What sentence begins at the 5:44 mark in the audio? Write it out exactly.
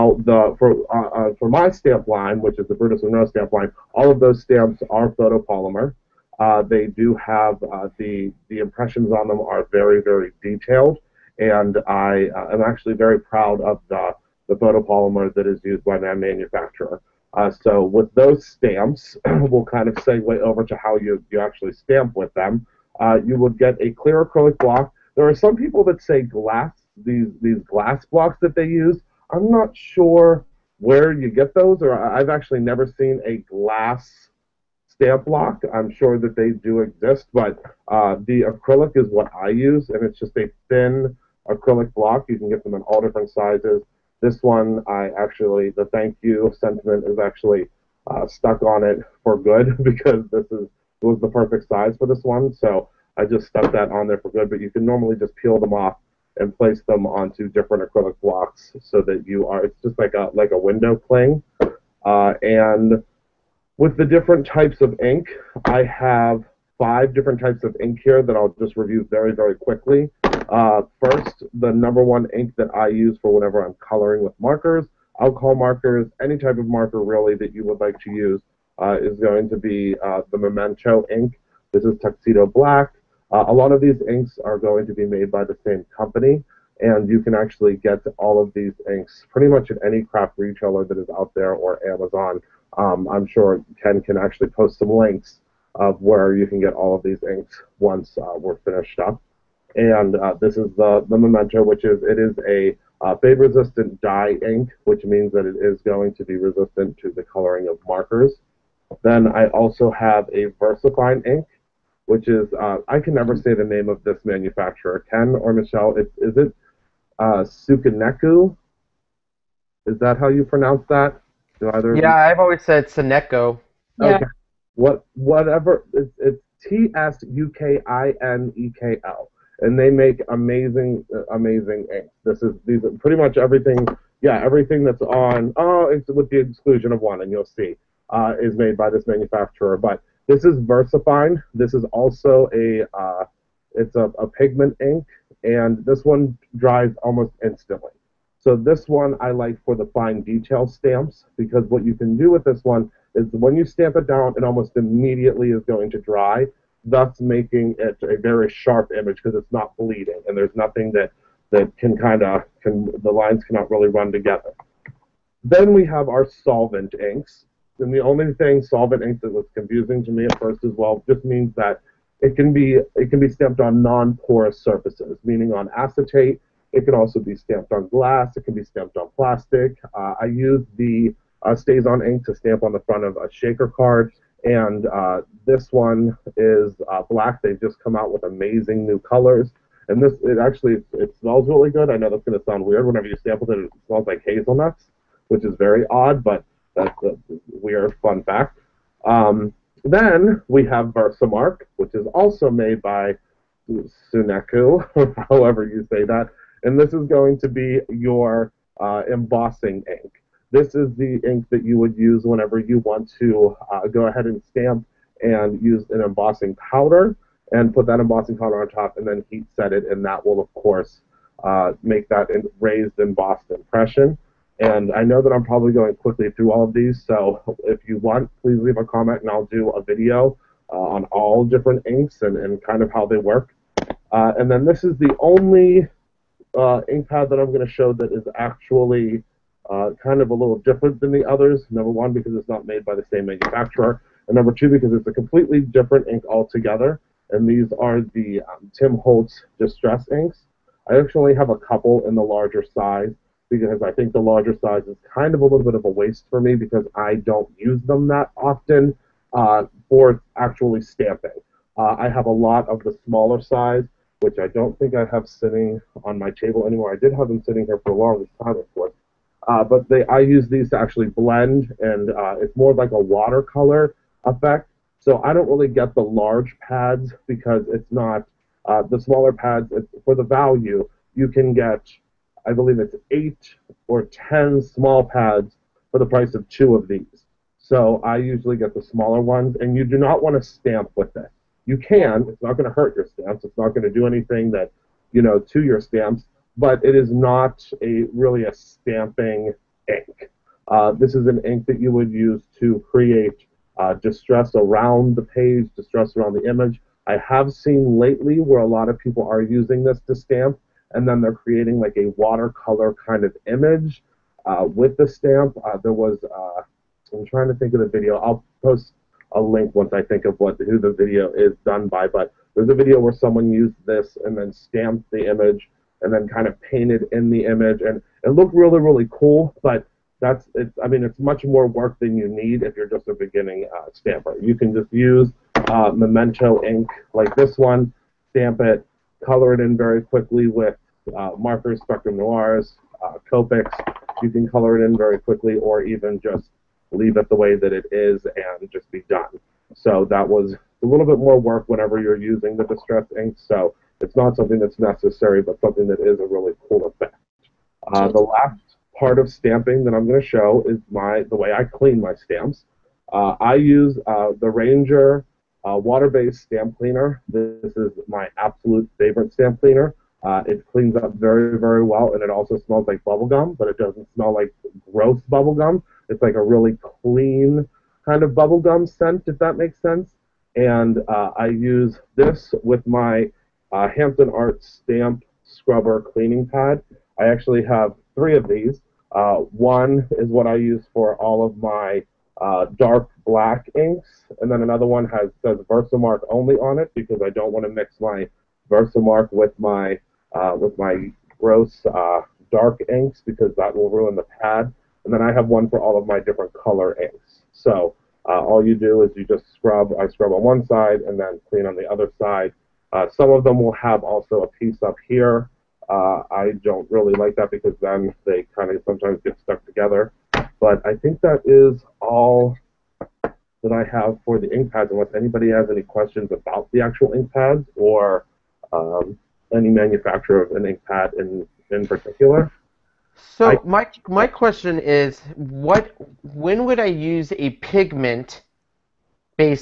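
You can color it in very quickly, or even just leave it the way that it is and just be done.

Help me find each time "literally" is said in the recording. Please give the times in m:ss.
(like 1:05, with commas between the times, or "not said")
not said.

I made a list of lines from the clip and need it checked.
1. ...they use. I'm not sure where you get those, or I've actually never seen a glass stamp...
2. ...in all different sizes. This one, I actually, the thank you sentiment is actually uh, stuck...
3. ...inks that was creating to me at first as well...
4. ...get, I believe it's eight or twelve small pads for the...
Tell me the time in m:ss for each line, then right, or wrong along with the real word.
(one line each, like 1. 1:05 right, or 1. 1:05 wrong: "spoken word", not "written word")
1. 0:28 right
2. 0:42 right
3. 2:49 wrong: "confusing", not "creating"
4. 4:41 wrong: "ten", not "twelve".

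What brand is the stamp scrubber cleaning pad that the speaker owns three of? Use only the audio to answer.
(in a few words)
Hampton Arts.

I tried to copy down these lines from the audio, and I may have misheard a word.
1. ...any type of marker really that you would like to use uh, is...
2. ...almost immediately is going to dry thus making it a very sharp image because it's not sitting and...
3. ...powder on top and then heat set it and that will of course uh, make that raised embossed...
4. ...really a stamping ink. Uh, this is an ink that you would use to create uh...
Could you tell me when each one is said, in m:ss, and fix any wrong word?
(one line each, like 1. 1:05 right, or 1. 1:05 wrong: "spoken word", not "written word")
1. 1:16 right
2. 2:34 wrong: "bleeding", not "sitting"
3. 3:38 right
4. 4:58 right.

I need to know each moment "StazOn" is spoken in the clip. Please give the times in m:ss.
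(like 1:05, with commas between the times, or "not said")
3:01.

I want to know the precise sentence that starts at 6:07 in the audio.
This is my absolute favorite stamp cleaner.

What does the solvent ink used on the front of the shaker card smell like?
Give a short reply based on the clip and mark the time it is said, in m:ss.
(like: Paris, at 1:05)
Hazelnuts, at 3:14.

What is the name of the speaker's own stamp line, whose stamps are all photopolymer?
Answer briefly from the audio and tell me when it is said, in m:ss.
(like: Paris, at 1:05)
Brutus Monroe, at 0:02.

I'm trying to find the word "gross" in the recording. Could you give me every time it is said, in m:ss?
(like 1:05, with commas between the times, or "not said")
6:14, 6:41.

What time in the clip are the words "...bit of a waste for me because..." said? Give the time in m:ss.
4:15.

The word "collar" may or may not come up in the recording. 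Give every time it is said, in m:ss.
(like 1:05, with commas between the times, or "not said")
not said.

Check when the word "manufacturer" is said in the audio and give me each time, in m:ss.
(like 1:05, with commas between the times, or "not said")
0:16, 1:54, 2:19, 4:03, 7:09.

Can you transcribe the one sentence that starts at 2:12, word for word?
This is these are pretty much everything.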